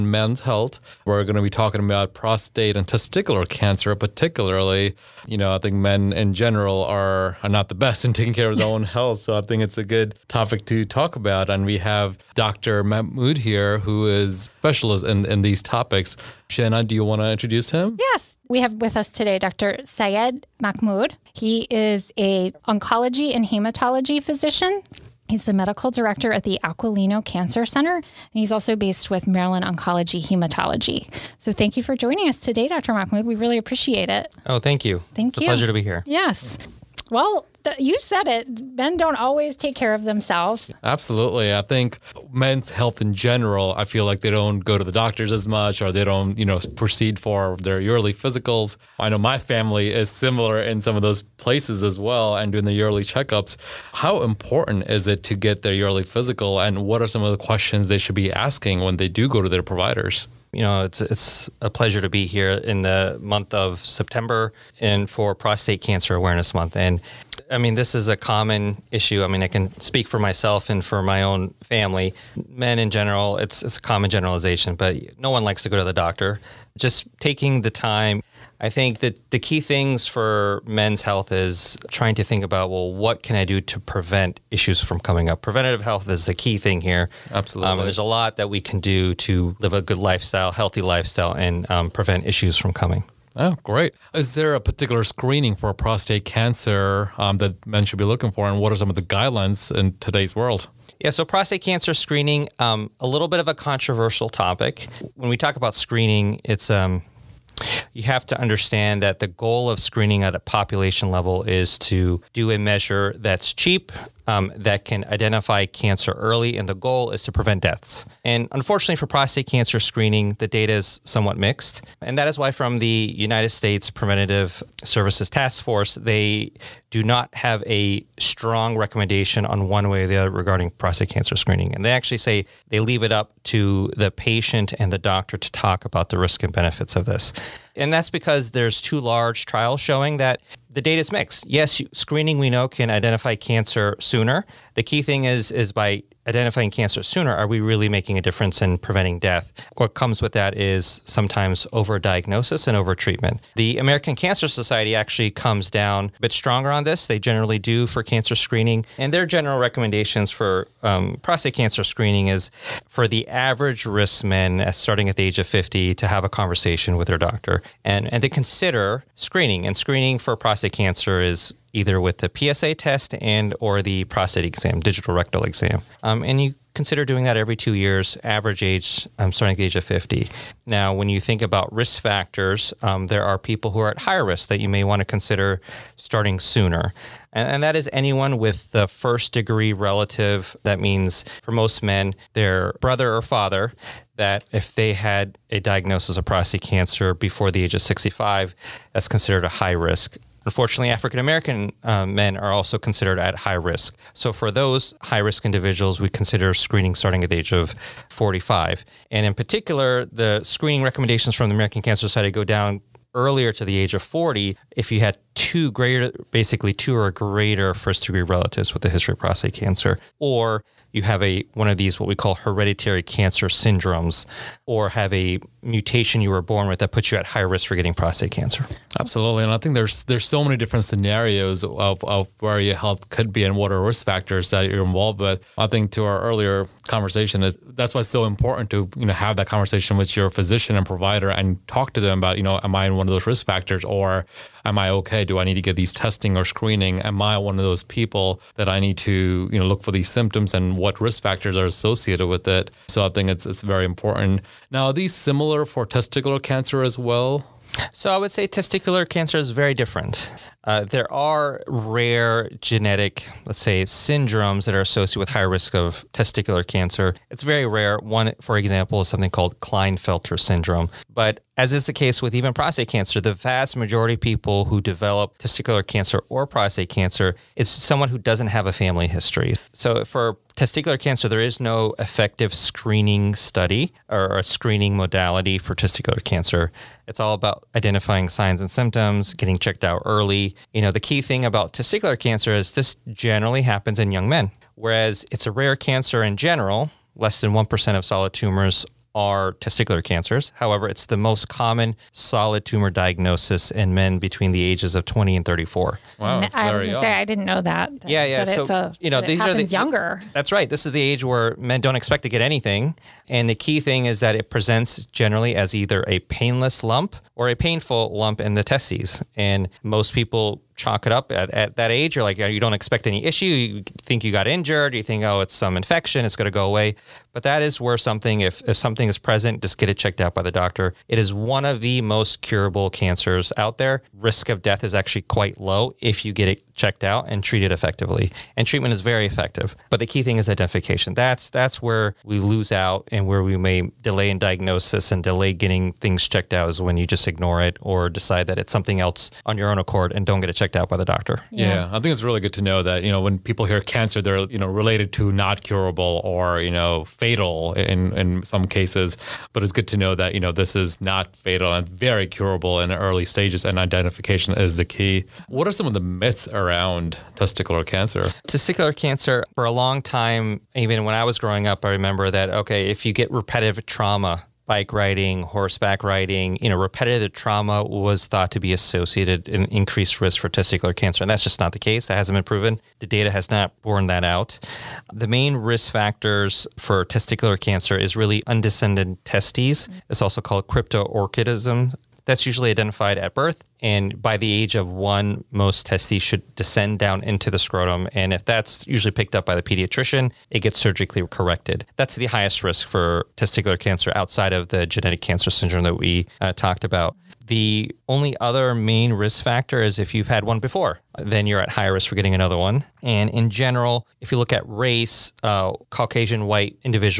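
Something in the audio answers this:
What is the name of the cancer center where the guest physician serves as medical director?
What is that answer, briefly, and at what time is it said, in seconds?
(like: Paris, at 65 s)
Aquilino Cancer Center, at 26 s.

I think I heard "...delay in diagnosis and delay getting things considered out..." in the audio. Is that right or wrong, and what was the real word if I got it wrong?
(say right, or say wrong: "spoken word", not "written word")
wrong: "checked", not "considered".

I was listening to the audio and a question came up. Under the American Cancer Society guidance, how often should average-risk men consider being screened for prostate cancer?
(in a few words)
Every 2 years.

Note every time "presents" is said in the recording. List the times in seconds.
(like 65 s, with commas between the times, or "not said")
314 s, 329 s.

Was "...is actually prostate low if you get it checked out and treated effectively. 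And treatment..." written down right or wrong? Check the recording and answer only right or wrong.
wrong.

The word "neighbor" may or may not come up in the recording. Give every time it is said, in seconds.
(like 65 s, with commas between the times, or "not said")
not said.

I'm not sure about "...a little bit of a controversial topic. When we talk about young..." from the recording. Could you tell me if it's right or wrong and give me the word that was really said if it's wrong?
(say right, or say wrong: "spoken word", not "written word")
wrong: "screening", not "young".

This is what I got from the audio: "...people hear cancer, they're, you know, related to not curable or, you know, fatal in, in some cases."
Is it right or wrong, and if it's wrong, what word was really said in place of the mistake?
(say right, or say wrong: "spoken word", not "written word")
right.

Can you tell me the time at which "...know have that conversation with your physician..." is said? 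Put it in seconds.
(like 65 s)
239 s.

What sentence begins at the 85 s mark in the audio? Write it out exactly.
Preventative health is a key thing here.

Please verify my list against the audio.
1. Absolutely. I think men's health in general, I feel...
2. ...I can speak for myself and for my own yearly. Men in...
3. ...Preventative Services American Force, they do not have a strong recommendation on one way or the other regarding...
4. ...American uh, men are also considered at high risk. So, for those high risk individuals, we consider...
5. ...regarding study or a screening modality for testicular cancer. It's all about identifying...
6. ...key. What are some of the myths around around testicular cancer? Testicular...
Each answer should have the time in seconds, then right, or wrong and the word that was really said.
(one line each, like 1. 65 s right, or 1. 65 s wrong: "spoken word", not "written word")
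1. 40 s right
2. 69 s wrong: "family", not "yearly"
3. 123 s wrong: "Task", not "American"
4. 201 s right
5. 282 s wrong: "screening", not "regarding"
6. 364 s right.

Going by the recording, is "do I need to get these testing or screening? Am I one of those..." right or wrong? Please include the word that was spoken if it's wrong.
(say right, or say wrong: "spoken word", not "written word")
right.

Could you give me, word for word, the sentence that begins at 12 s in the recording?
Mahmood here, who is specialist in, in these topics.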